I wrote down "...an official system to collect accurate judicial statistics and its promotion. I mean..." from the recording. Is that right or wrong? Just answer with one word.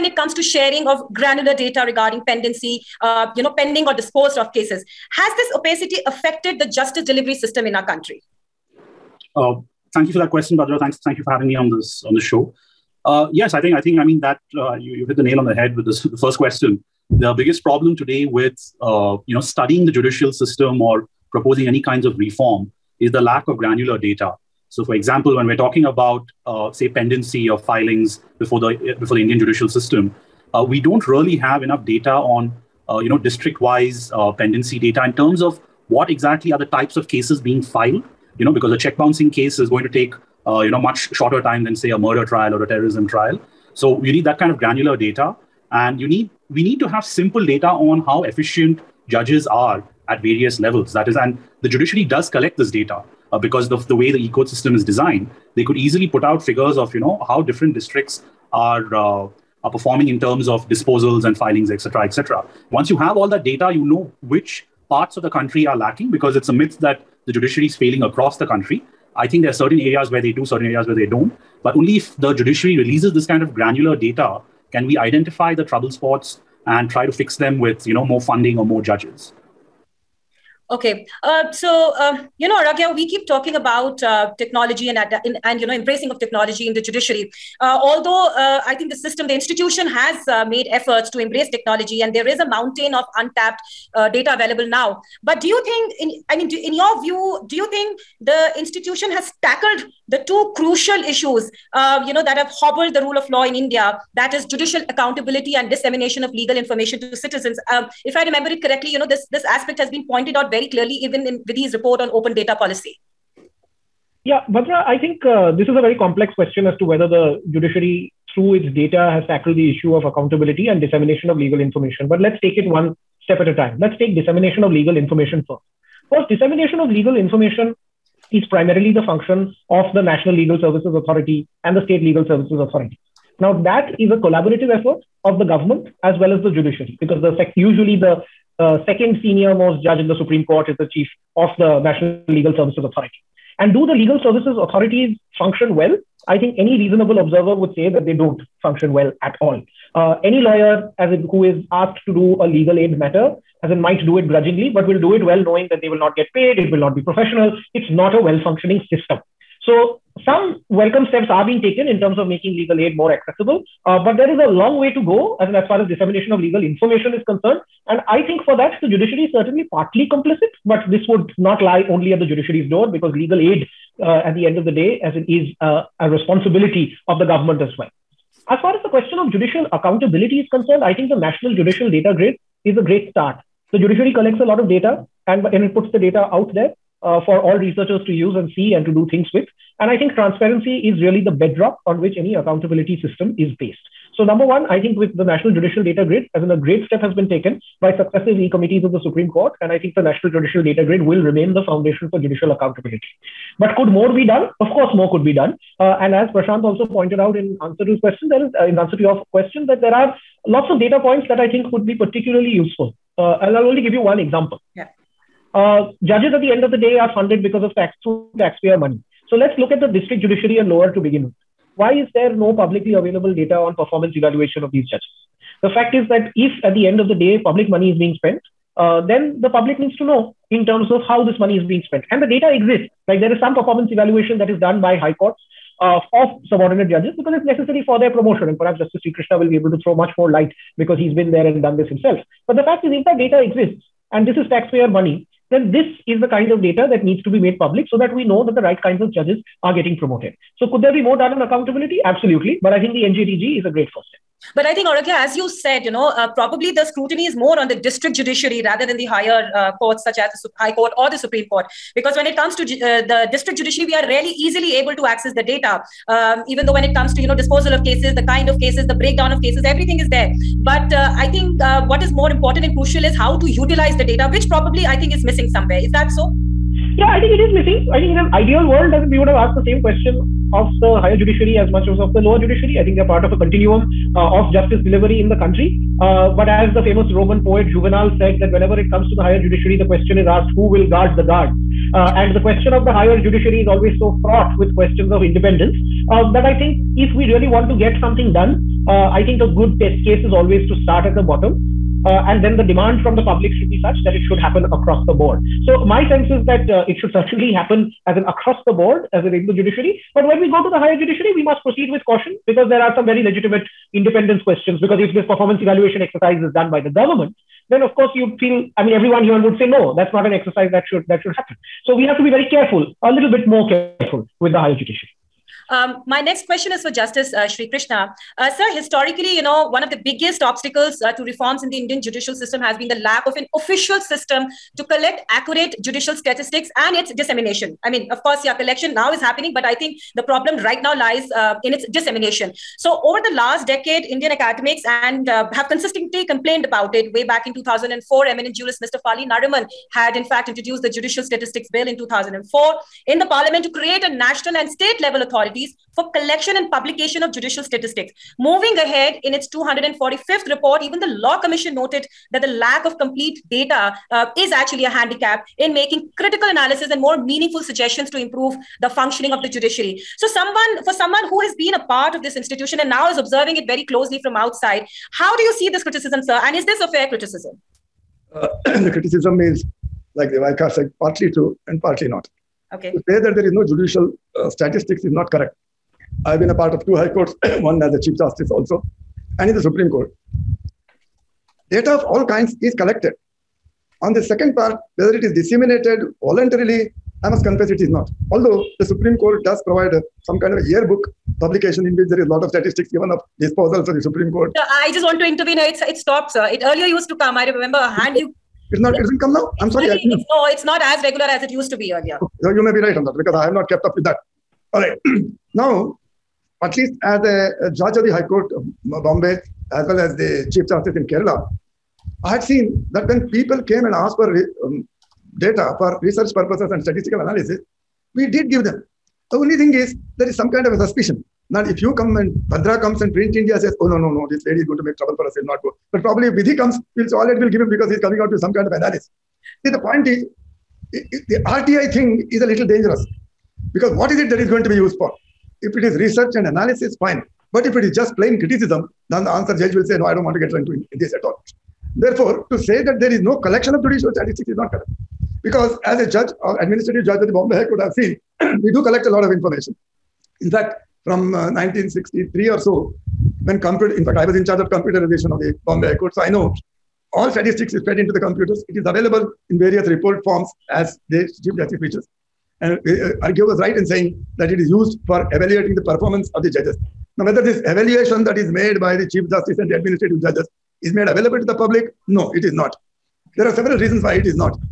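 wrong.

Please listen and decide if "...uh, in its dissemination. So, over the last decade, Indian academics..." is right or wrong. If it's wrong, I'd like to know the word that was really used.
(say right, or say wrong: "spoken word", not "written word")
right.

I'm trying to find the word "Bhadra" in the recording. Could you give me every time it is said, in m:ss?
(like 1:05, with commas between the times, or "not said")
0:10, 1:54, 7:12.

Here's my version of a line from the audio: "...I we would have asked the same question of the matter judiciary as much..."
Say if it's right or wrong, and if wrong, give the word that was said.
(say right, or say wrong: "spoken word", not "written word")
wrong: "higher", not "matter".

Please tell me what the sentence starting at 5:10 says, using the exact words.
But when we go to the higher judiciary, we must proceed with caution because there are some very legitimate independence questions.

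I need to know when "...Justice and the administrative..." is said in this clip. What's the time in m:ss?
7:59.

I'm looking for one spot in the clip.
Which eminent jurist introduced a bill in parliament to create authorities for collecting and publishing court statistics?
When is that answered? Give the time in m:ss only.
5:49.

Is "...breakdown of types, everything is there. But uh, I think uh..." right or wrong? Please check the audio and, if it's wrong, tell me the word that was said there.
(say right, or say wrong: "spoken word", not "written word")
wrong: "cases", not "types".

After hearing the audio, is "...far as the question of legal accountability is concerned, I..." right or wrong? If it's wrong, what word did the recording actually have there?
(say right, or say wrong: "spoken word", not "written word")
wrong: "judicial", not "legal".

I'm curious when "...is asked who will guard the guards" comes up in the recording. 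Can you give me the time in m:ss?
4:50.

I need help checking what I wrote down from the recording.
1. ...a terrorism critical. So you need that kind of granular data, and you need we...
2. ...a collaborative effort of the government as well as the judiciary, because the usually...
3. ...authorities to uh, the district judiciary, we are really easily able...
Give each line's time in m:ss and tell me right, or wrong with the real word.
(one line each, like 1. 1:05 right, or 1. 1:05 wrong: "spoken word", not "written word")
1. 0:42 wrong: "trial", not "critical"
2. 2:14 right
3. 4:22 wrong: "comes", not "authorities".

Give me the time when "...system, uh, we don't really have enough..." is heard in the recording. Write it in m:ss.
0:29.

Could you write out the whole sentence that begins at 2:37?
It's not a well functioning system.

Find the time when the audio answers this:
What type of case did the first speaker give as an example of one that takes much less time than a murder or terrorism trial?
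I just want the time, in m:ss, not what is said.
0:38.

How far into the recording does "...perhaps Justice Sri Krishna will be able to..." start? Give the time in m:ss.
3:58.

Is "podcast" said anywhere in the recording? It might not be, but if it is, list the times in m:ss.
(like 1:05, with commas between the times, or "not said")
not said.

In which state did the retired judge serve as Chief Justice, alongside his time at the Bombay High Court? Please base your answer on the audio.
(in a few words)
Kerala.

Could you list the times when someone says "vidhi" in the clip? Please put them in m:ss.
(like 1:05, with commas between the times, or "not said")
1:51, 7:16.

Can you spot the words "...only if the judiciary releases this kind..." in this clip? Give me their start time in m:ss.
1:11.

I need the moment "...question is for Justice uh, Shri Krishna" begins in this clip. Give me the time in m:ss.
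5:26.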